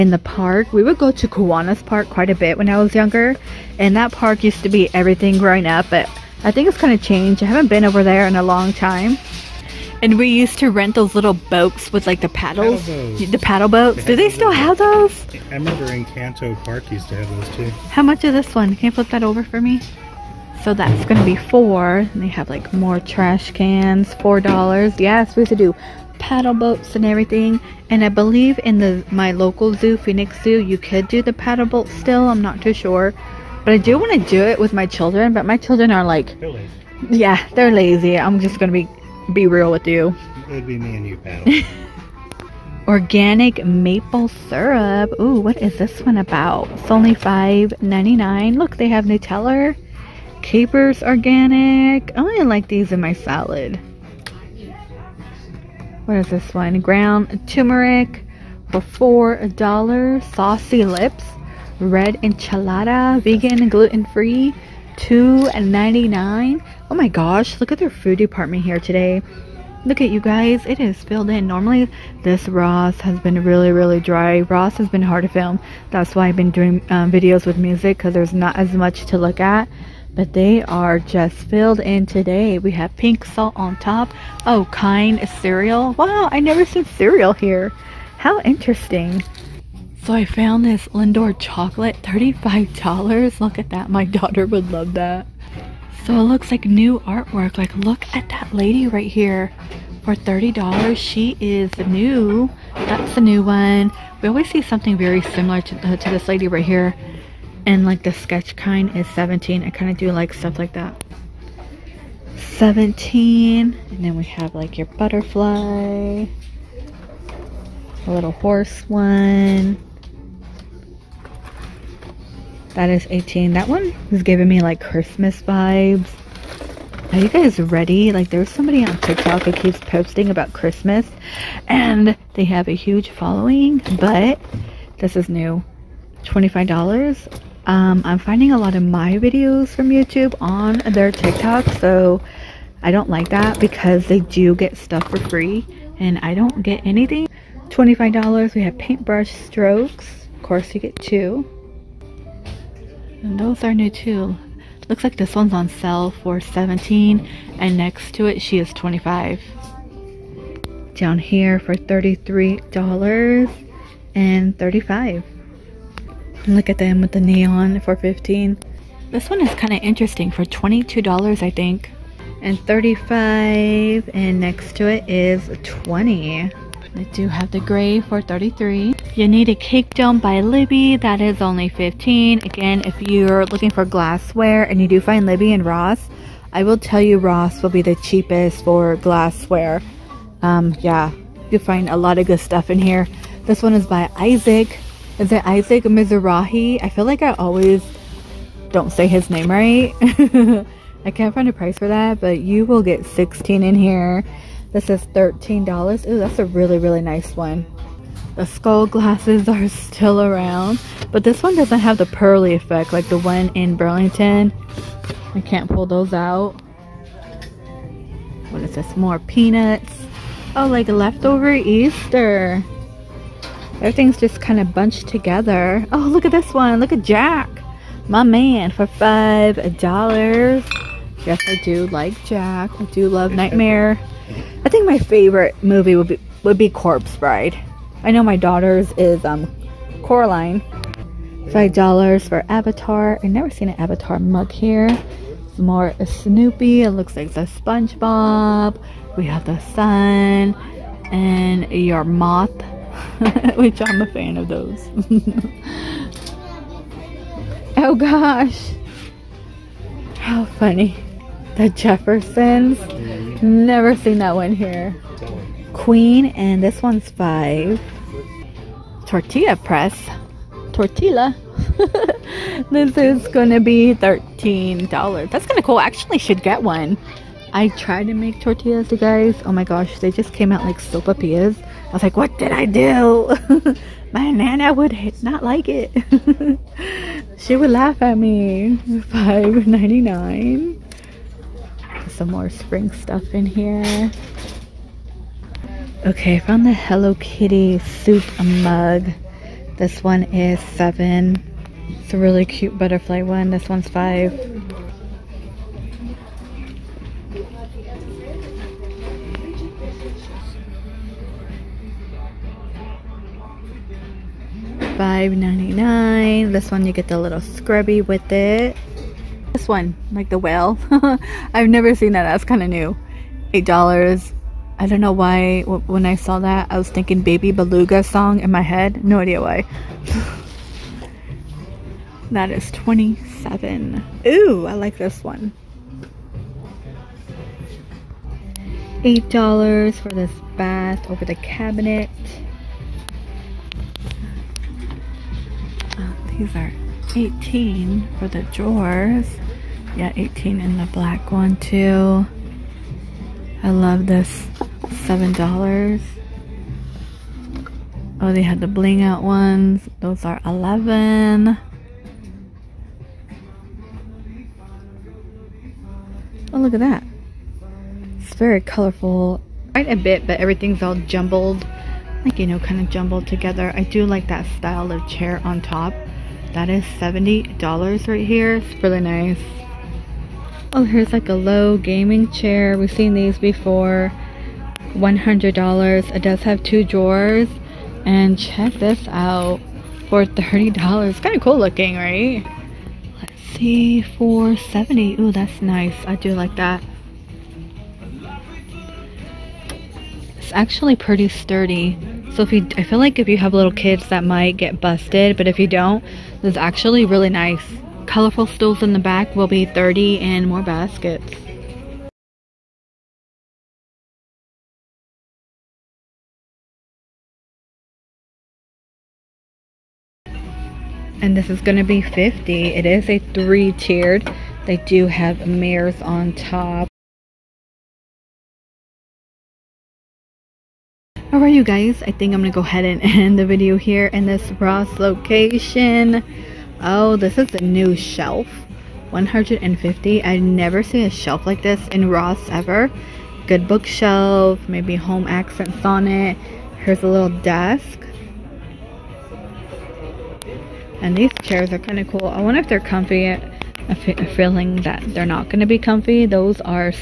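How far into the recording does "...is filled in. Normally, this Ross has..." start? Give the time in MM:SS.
01:10.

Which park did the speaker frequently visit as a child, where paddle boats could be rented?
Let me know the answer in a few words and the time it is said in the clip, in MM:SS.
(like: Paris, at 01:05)
Kiwanis Park, at 00:01.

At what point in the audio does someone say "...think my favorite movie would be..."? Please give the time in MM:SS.
03:54.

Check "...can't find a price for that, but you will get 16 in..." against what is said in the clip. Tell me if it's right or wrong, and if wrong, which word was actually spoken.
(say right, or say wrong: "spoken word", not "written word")
right.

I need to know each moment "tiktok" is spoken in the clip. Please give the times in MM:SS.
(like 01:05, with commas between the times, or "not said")
02:09, 02:21.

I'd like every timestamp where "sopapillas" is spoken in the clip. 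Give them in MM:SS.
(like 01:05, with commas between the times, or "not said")
04:40.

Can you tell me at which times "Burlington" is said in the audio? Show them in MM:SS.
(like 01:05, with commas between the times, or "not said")
03:33.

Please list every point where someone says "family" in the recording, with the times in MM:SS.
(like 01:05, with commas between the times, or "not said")
not said.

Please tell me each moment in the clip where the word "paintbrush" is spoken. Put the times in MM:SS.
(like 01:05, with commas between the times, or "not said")
02:28.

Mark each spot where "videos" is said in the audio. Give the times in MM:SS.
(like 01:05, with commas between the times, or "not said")
01:17, 02:19, 07:13.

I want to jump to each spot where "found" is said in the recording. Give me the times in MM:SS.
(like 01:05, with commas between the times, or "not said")
01:30, 04:56.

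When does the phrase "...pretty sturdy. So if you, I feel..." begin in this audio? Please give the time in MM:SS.
06:40.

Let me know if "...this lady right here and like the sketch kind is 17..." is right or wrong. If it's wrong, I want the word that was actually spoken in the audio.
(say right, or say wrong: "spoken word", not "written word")
right.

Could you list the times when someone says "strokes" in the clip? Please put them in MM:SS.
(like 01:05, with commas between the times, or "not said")
02:29.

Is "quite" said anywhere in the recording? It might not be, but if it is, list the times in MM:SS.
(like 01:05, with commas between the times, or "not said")
00:02, 06:09.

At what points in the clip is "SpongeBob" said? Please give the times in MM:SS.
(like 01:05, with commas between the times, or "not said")
04:07.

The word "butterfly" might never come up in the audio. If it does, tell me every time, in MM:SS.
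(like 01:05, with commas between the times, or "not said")
01:54, 05:02.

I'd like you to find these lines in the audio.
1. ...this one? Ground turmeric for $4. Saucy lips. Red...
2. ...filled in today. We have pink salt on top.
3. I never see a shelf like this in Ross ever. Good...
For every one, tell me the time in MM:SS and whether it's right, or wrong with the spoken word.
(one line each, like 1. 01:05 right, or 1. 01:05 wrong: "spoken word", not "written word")
1. 00:56 right
2. 01:21 right
3. 07:20 right.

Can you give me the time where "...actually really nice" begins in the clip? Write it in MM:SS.
06:46.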